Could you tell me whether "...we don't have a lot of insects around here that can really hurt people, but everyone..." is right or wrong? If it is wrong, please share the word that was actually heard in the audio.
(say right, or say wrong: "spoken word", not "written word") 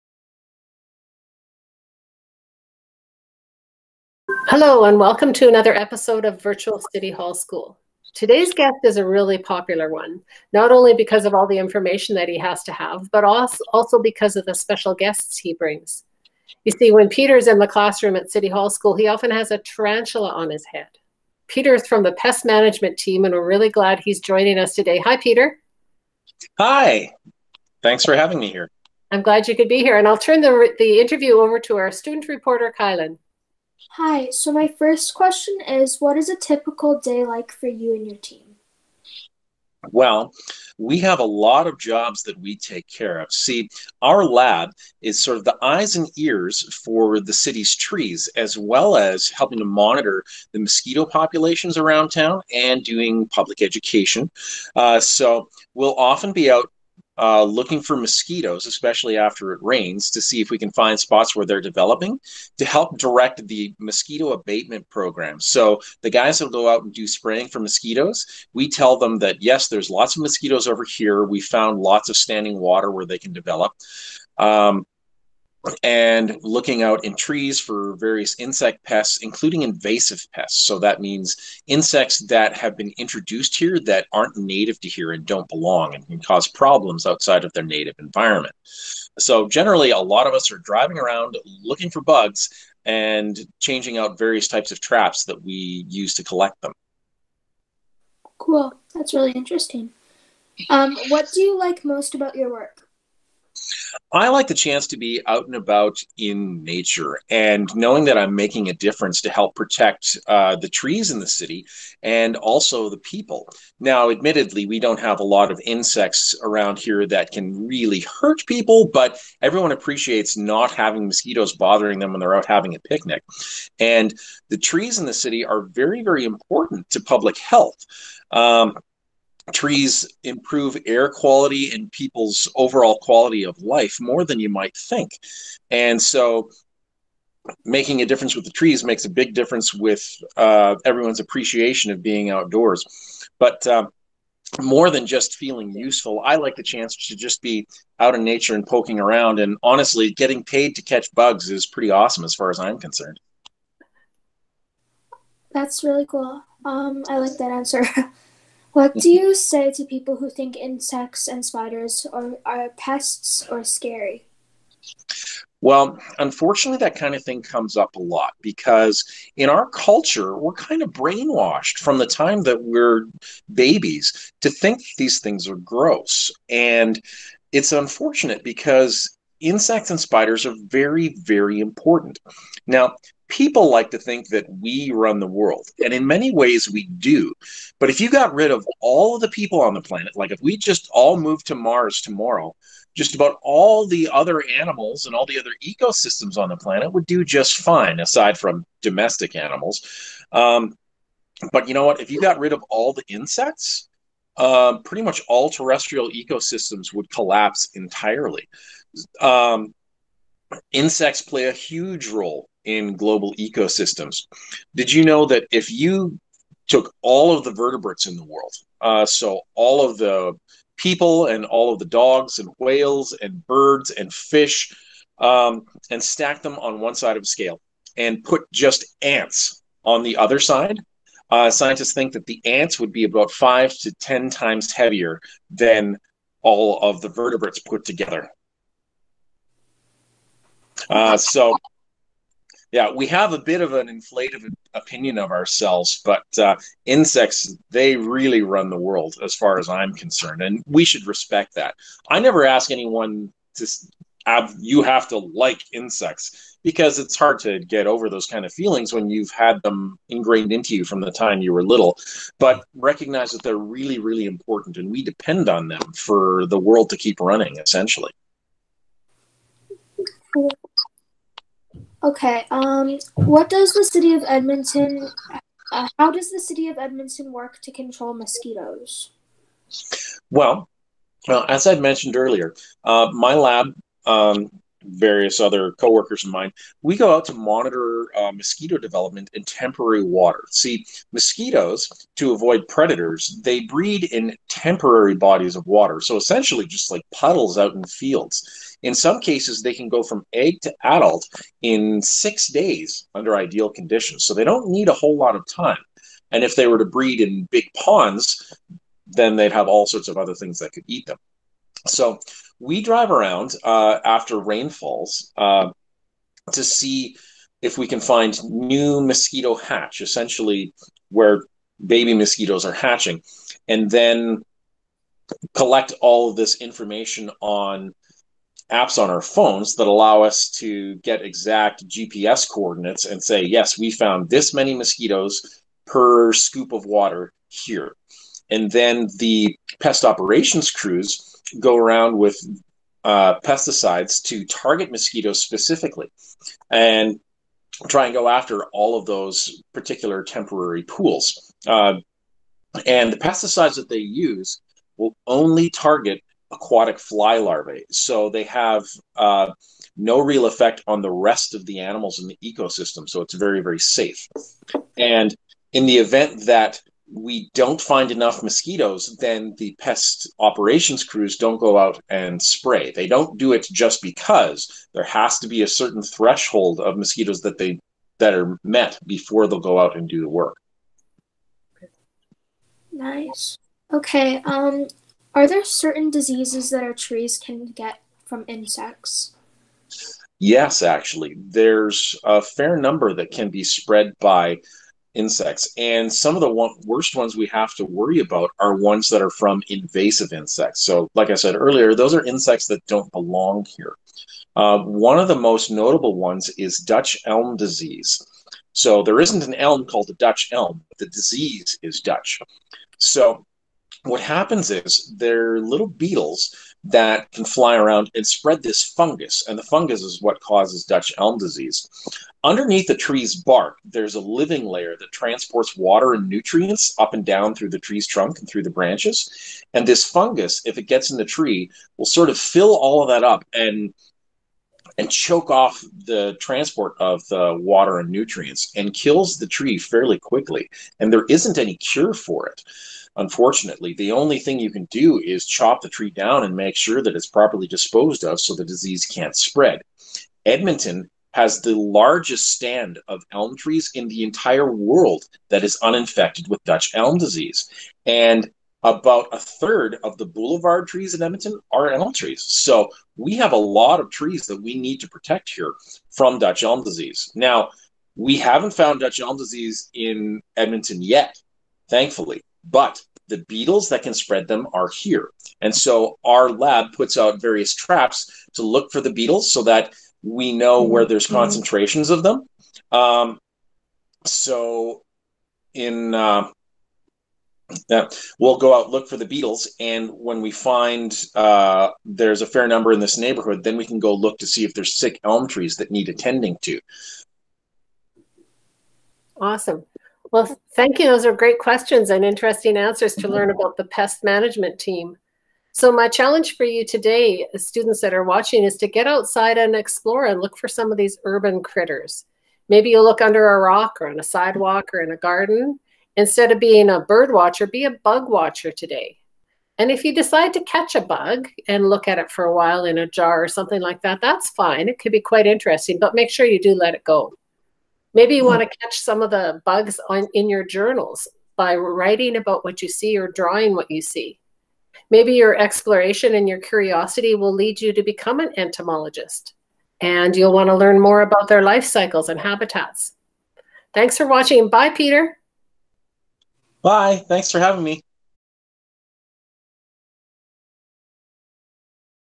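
right.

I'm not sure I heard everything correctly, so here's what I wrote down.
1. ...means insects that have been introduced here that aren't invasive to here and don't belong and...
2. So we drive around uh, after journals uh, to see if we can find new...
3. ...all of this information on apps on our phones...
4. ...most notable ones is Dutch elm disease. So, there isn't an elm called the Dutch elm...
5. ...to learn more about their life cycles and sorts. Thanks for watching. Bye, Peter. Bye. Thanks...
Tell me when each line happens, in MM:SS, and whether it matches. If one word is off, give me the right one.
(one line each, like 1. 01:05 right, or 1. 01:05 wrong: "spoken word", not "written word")
1. 01:21 wrong: "native", not "invasive"
2. 05:11 wrong: "rainfalls", not "journals"
3. 05:26 right
4. 06:45 right
5. 09:00 wrong: "habitats", not "sorts".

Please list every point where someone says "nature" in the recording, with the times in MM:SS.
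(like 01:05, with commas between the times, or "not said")
01:46, 02:28.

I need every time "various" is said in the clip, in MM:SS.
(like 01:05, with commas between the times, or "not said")
01:17, 01:34, 04:44, 07:57.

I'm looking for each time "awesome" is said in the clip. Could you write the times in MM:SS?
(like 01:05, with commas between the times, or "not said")
02:31, 08:19.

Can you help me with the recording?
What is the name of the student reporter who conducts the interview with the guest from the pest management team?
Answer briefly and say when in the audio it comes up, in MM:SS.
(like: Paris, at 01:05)
Kylan, at 00:32.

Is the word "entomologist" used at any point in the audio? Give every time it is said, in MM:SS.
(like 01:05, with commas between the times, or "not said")
08:58.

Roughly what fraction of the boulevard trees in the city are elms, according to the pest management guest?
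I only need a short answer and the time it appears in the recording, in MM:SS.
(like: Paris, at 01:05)
About a third, at 07:38.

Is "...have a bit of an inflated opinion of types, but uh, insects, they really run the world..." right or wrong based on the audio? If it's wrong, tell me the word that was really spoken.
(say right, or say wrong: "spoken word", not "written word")
wrong: "ourselves", not "types".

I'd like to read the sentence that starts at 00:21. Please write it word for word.
Peter is from the pest management team, and we're really glad he's joining us today.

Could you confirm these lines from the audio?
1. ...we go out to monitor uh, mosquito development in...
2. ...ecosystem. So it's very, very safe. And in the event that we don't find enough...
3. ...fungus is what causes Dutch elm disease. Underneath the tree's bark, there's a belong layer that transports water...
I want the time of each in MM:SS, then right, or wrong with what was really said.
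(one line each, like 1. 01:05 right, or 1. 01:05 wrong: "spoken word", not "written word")
1. 04:46 right
2. 06:02 right
3. 06:59 wrong: "living", not "belong".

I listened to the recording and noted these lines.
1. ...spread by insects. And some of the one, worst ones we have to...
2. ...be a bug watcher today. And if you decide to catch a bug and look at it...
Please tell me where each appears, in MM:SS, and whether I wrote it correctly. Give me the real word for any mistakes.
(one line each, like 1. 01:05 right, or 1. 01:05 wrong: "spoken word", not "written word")
1. 06:33 right
2. 08:37 right.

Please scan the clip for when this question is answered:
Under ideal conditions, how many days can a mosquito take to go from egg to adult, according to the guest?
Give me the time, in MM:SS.
05:02.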